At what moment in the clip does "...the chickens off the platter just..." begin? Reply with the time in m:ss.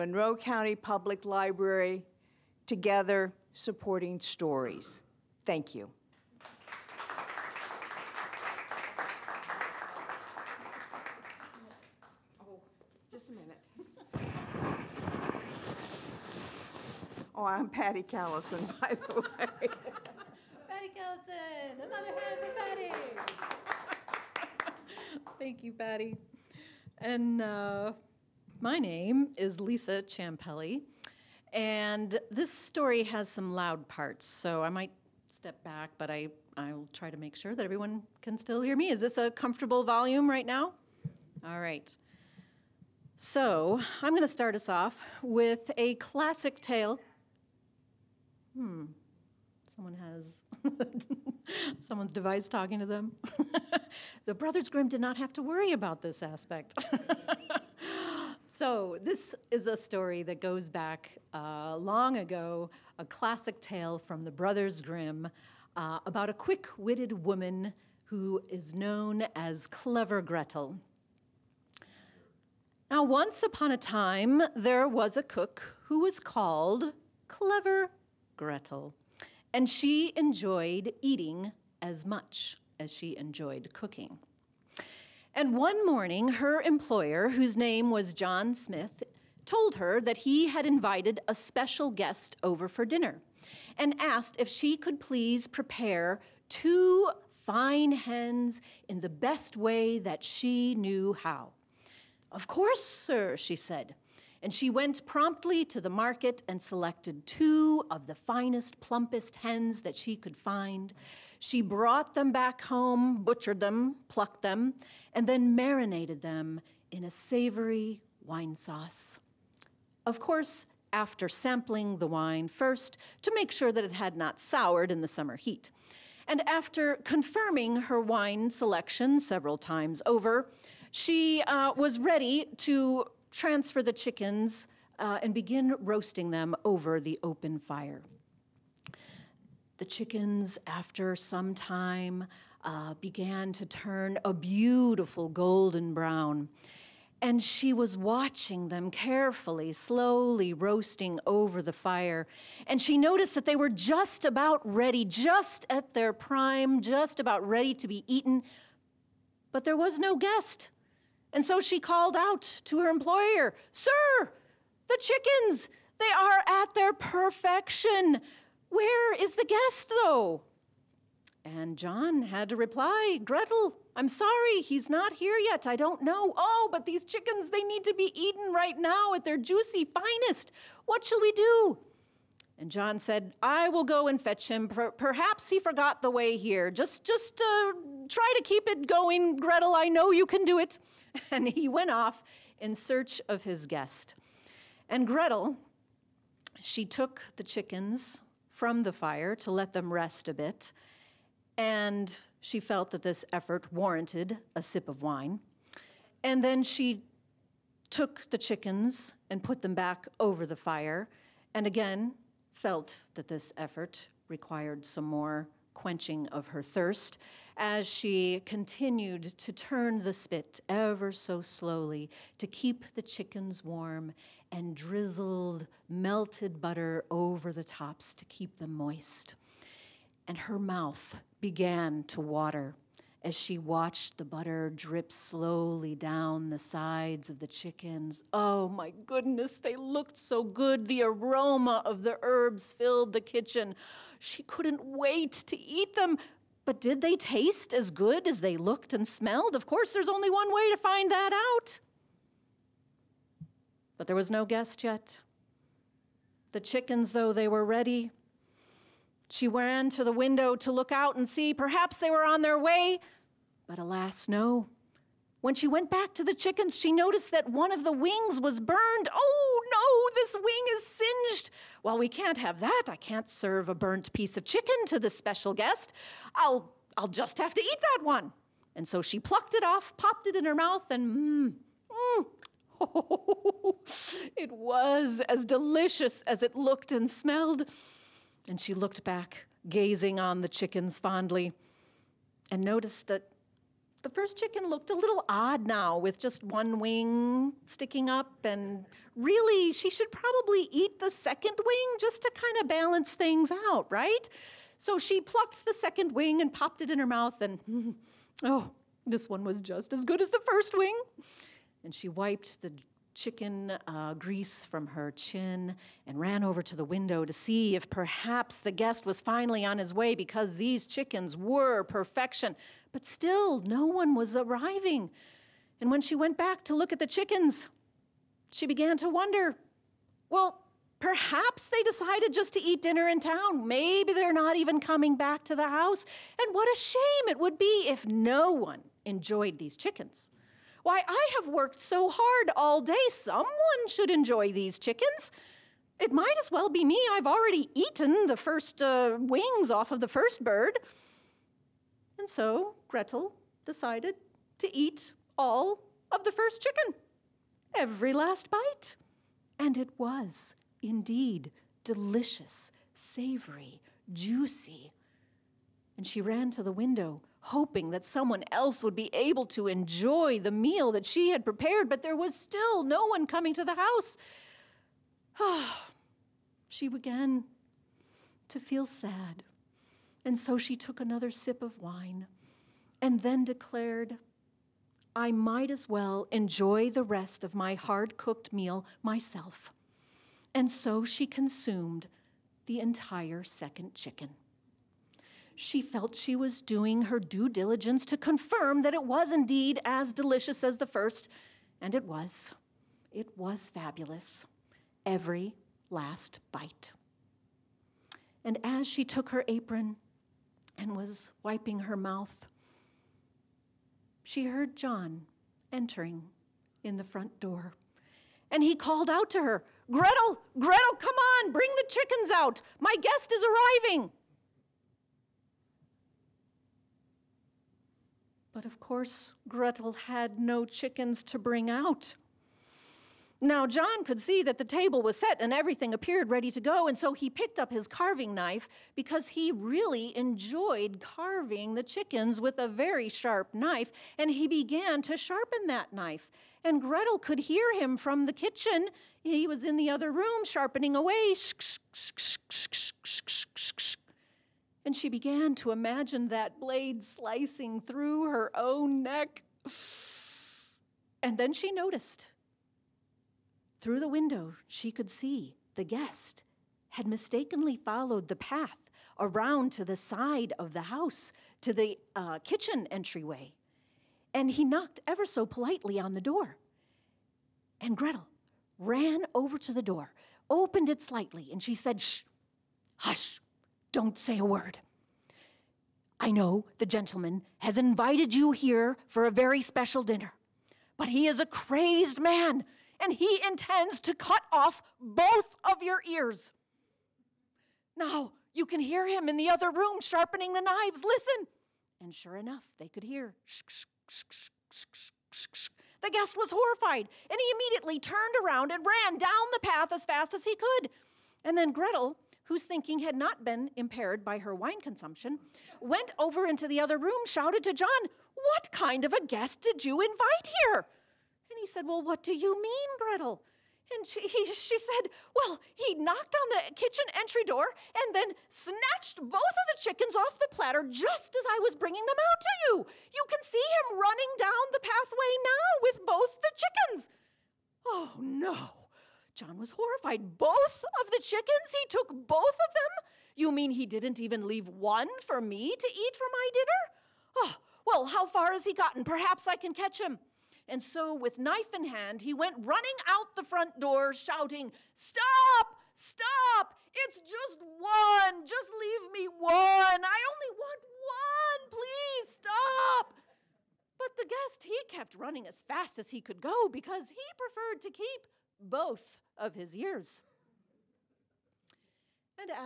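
8:49.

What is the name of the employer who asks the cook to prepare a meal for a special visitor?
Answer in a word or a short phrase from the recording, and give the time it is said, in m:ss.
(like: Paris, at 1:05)
John Smith, at 1:28.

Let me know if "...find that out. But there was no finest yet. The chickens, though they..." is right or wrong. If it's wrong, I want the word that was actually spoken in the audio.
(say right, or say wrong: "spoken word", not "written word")
wrong: "guest", not "finest".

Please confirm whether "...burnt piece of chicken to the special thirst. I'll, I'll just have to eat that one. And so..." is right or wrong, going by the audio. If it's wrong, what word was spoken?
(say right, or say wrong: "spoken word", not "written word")
wrong: "guest", not "thirst".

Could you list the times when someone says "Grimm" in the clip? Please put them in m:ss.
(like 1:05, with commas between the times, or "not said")
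0:54, 1:04.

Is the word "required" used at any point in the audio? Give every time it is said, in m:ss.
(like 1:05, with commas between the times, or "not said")
3:34.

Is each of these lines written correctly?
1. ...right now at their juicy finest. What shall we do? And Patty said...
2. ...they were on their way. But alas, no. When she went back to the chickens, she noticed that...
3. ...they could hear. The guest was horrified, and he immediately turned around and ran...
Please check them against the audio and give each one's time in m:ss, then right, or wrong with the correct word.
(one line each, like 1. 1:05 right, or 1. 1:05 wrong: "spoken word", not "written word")
1. 2:58 wrong: "John", not "Patty"
2. 4:21 right
3. 8:22 right.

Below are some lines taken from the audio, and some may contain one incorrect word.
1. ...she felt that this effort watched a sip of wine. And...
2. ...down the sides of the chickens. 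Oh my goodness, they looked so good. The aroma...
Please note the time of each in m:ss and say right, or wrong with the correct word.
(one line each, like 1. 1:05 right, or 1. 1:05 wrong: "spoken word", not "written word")
1. 3:22 wrong: "warranted", not "watched"
2. 3:55 right.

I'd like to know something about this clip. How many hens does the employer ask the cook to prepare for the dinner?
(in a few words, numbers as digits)
2.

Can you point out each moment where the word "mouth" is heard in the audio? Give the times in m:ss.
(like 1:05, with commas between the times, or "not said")
3:50, 4:40, 5:07, 6:51.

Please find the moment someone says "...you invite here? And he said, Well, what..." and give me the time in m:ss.
8:39.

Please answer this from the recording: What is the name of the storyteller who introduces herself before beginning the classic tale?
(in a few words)
Lisa Champelli.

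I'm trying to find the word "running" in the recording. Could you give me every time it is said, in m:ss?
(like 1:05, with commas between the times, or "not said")
8:53, 9:12, 9:25.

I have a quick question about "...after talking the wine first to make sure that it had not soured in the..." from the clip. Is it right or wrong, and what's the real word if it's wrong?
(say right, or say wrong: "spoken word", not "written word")
wrong: "sampling", not "talking".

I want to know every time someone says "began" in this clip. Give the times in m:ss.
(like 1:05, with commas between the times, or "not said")
2:23, 3:51, 5:28, 6:16, 7:24, 7:35.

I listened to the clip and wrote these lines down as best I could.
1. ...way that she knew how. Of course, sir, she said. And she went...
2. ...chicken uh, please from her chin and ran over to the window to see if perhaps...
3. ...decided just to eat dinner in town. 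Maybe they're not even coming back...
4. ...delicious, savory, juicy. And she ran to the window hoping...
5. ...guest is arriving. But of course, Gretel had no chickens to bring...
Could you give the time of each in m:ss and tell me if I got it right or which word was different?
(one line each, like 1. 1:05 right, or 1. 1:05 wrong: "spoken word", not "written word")
1. 1:39 right
2. 5:13 wrong: "grease", not "please"
3. 5:31 right
4. 6:01 right
5. 7:03 right.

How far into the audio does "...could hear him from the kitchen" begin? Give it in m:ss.
7:27.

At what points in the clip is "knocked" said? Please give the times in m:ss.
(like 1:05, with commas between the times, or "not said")
7:54, 8:45.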